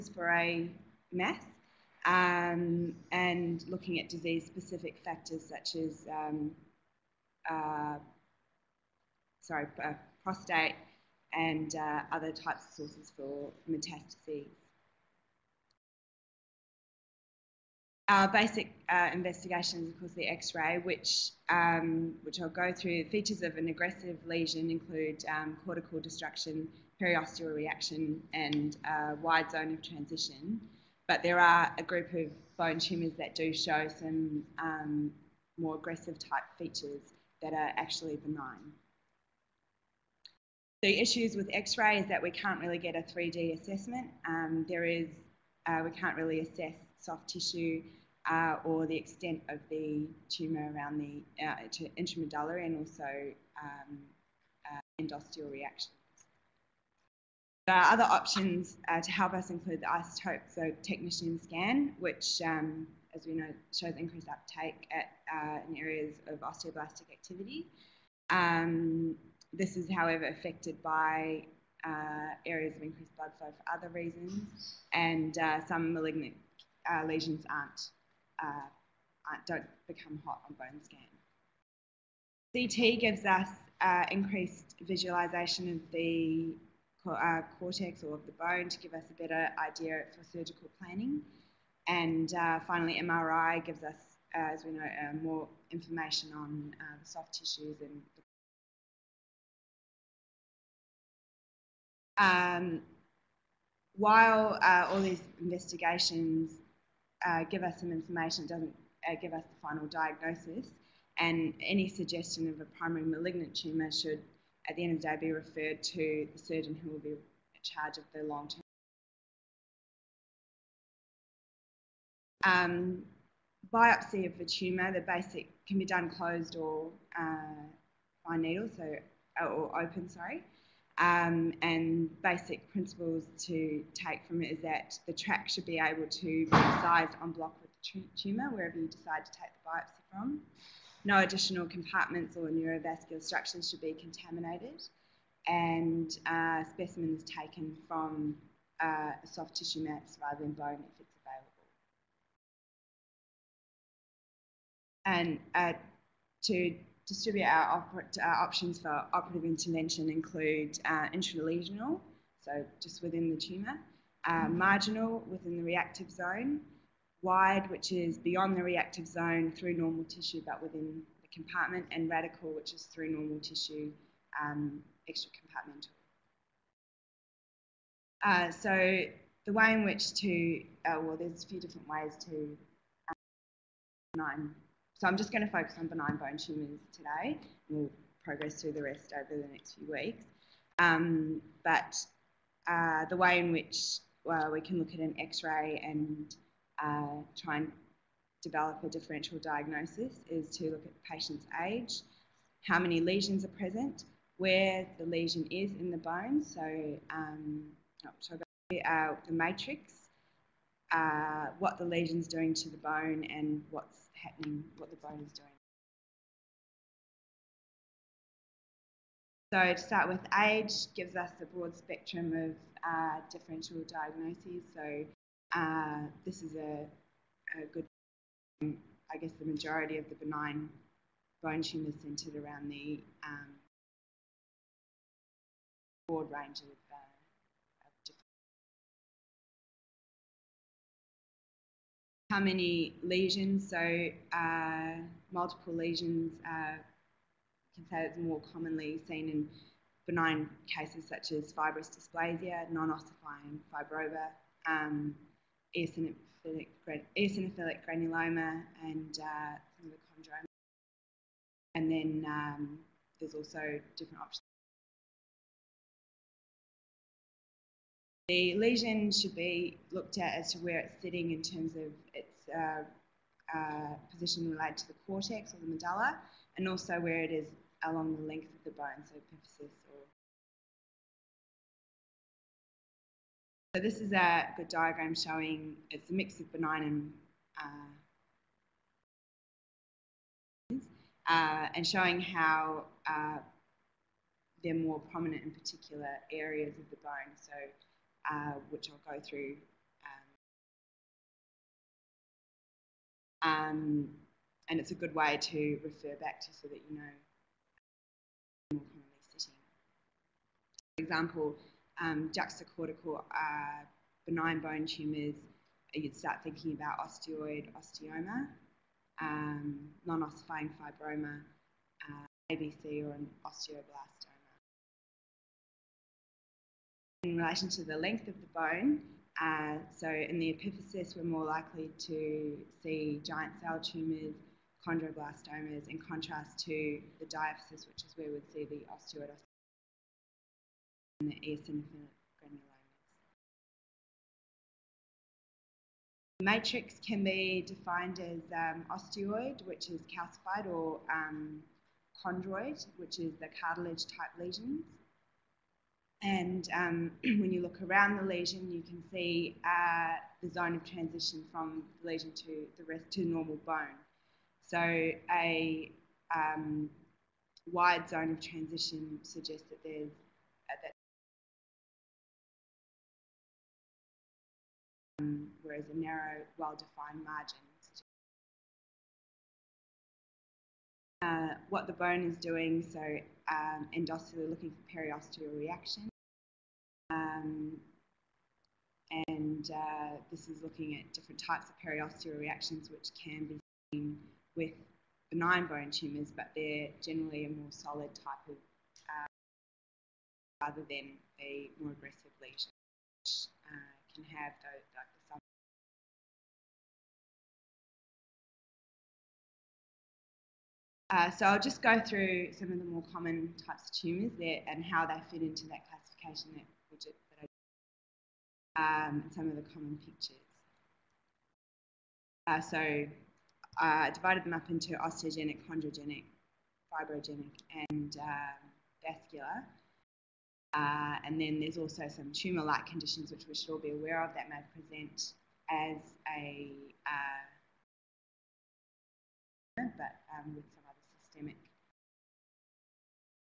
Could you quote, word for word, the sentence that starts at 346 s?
Matrix can be defined as um, osteoid, which is calcified, or um, chondroid, which is the cartilage type lesions.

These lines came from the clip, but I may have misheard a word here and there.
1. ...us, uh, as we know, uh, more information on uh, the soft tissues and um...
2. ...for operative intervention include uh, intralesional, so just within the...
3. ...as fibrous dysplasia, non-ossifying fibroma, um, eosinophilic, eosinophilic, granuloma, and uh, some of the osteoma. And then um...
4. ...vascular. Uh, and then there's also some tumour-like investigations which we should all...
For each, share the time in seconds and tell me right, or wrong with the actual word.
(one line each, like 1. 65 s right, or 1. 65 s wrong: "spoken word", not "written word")
1. 93 s right
2. 158 s right
3. 251 s wrong: "chondroma", not "osteoma"
4. 429 s wrong: "conditions", not "investigations".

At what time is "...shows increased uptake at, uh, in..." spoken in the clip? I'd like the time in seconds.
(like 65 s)
63 s.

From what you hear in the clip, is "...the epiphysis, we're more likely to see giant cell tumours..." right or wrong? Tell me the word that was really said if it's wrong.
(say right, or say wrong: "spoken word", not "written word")
right.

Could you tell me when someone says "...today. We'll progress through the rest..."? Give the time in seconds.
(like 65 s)
186 s.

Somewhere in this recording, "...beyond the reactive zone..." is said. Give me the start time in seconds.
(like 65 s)
168 s.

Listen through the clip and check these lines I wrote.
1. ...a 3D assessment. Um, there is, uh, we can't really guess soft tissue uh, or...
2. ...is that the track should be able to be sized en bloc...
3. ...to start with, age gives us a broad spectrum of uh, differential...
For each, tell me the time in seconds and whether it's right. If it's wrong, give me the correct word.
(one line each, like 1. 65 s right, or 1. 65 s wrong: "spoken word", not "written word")
1. 42 s wrong: "assess", not "guess"
2. 134 s right
3. 219 s right.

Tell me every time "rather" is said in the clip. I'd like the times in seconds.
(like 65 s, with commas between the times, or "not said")
150 s, 400 s.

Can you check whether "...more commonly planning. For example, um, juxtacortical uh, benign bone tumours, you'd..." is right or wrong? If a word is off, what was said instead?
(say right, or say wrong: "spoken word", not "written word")
wrong: "sitting", not "planning".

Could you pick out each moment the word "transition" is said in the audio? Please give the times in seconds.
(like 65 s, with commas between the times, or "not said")
29 s, 360 s, 368 s.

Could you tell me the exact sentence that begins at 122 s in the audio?
Um, biopsy of the tumour, the basic can be done closed or uh, by needle, so uh, or open, sorry.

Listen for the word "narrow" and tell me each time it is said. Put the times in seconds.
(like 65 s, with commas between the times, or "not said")
375 s.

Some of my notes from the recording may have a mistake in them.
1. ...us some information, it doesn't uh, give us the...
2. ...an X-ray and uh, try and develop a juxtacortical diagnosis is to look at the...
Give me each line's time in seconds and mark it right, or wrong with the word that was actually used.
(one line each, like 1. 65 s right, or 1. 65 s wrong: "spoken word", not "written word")
1. 107 s right
2. 194 s wrong: "differential", not "juxtacortical".